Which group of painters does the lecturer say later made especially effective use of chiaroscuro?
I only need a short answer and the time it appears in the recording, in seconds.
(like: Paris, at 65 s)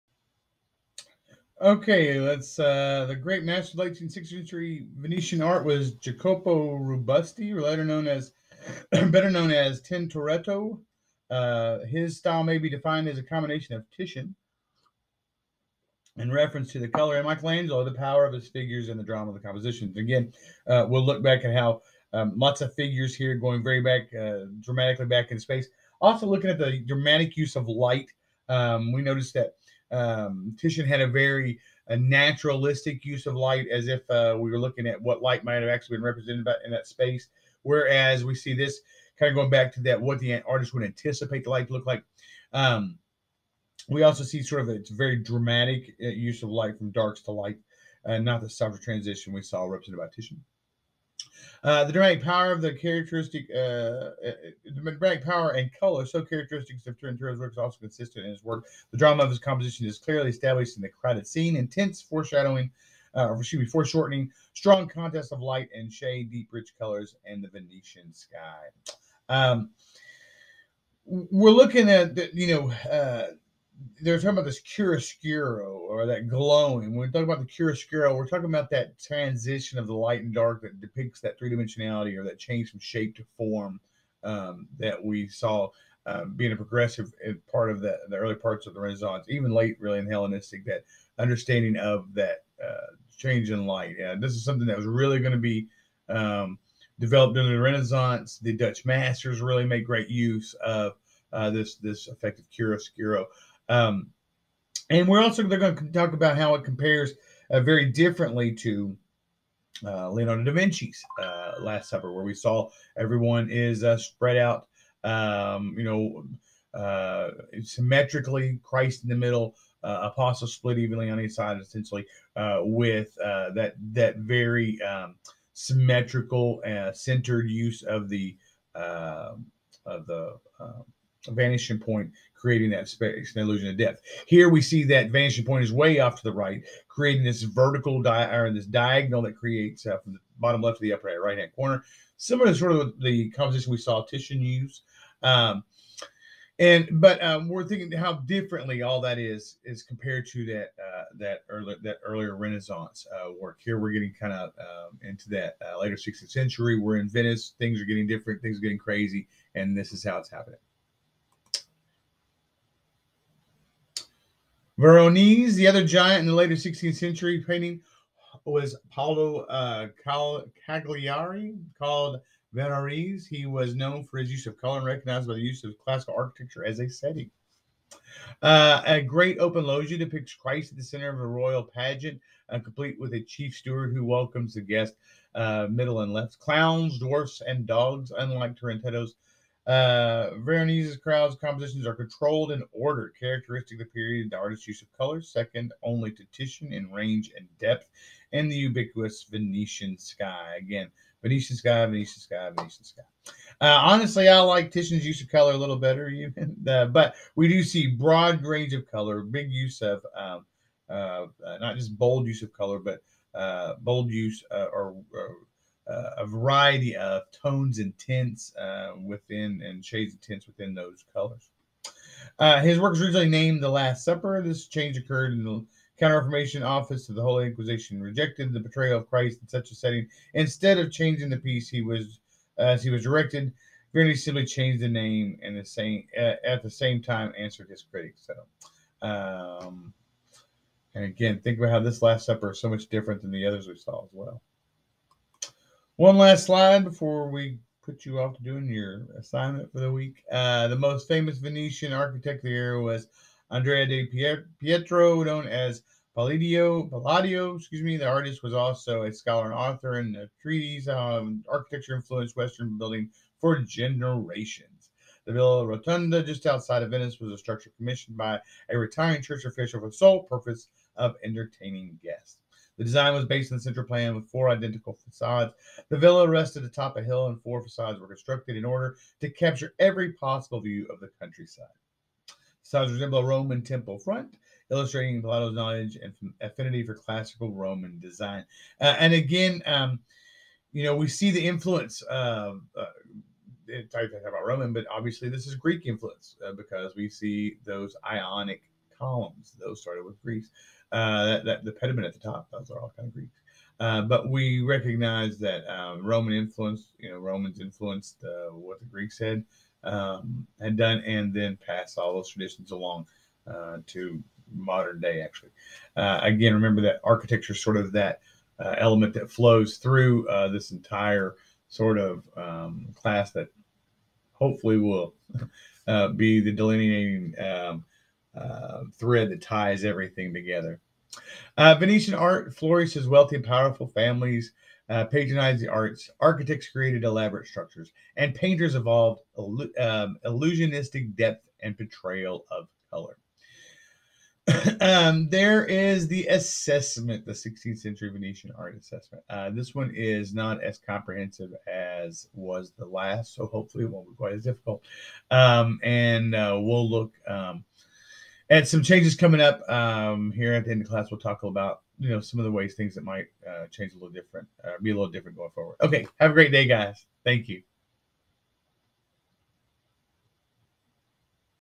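The Dutch masters, at 98 s.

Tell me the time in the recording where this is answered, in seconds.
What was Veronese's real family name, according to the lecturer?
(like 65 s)
170 s.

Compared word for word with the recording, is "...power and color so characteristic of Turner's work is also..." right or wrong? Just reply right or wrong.
right.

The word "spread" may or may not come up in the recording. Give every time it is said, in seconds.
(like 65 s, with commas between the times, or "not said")
113 s.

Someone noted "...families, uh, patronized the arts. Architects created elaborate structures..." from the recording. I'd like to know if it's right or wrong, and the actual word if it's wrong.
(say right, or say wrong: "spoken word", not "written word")
right.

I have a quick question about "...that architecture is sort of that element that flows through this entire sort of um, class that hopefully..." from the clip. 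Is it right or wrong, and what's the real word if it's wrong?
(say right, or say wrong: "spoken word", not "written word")
right.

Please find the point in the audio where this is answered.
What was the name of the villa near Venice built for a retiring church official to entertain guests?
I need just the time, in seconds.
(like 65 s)
265 s.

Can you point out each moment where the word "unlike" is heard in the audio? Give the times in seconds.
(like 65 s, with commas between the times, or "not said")
188 s.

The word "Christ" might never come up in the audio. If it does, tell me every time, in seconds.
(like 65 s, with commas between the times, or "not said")
118 s, 180 s, 229 s.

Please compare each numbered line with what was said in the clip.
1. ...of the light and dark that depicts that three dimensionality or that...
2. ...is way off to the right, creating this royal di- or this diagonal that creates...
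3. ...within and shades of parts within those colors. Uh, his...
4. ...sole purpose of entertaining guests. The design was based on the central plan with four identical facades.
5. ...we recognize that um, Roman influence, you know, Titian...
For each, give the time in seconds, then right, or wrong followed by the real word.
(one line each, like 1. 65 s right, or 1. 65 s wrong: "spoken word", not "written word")
1. 79 s right
2. 135 s wrong: "vertical", not "royal"
3. 219 s wrong: "tints", not "parts"
4. 269 s right
5. 304 s wrong: "Romans", not "Titian".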